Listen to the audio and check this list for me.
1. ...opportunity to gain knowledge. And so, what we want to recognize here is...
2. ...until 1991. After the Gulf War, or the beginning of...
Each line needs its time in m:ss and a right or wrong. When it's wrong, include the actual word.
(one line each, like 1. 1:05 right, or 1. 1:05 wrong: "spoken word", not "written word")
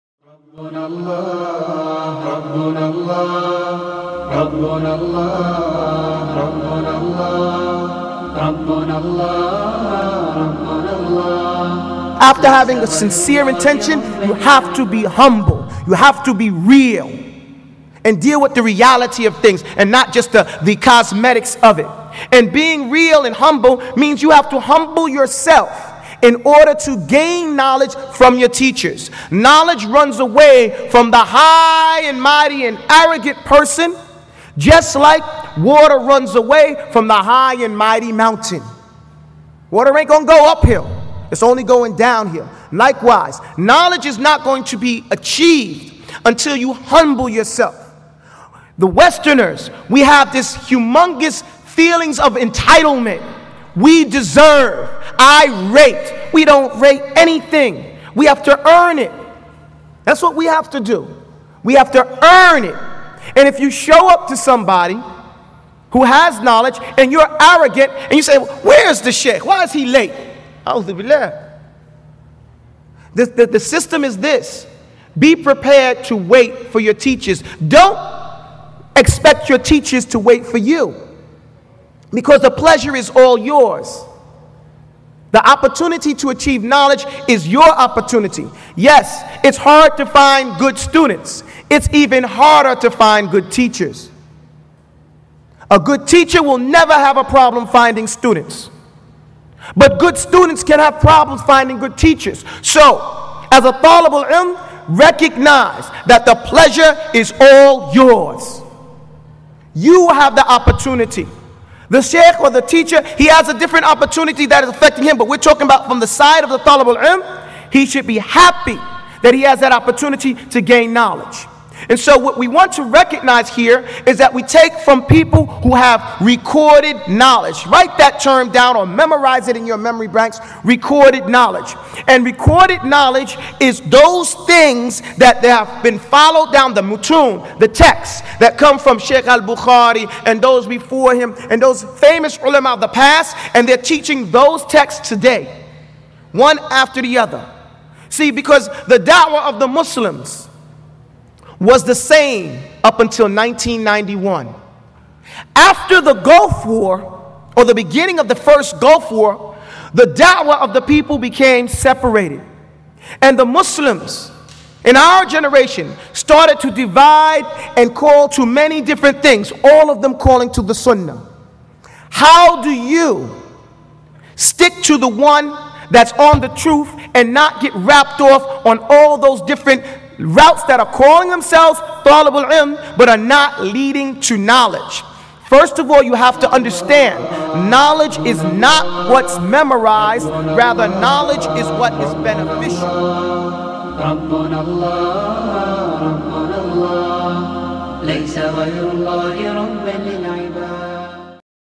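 1. 1:59 right
2. 2:32 right.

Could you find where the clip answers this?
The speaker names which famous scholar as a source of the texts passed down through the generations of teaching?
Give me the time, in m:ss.
2:18.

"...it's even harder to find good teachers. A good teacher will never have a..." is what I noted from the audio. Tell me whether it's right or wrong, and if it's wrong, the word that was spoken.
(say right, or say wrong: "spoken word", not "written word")
right.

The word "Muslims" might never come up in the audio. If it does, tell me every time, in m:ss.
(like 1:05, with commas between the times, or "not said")
2:29, 2:43.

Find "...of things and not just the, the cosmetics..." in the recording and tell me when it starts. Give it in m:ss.
0:19.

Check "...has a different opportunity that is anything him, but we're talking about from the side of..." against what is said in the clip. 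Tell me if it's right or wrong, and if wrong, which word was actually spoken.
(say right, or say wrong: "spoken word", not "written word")
wrong: "affecting", not "anything".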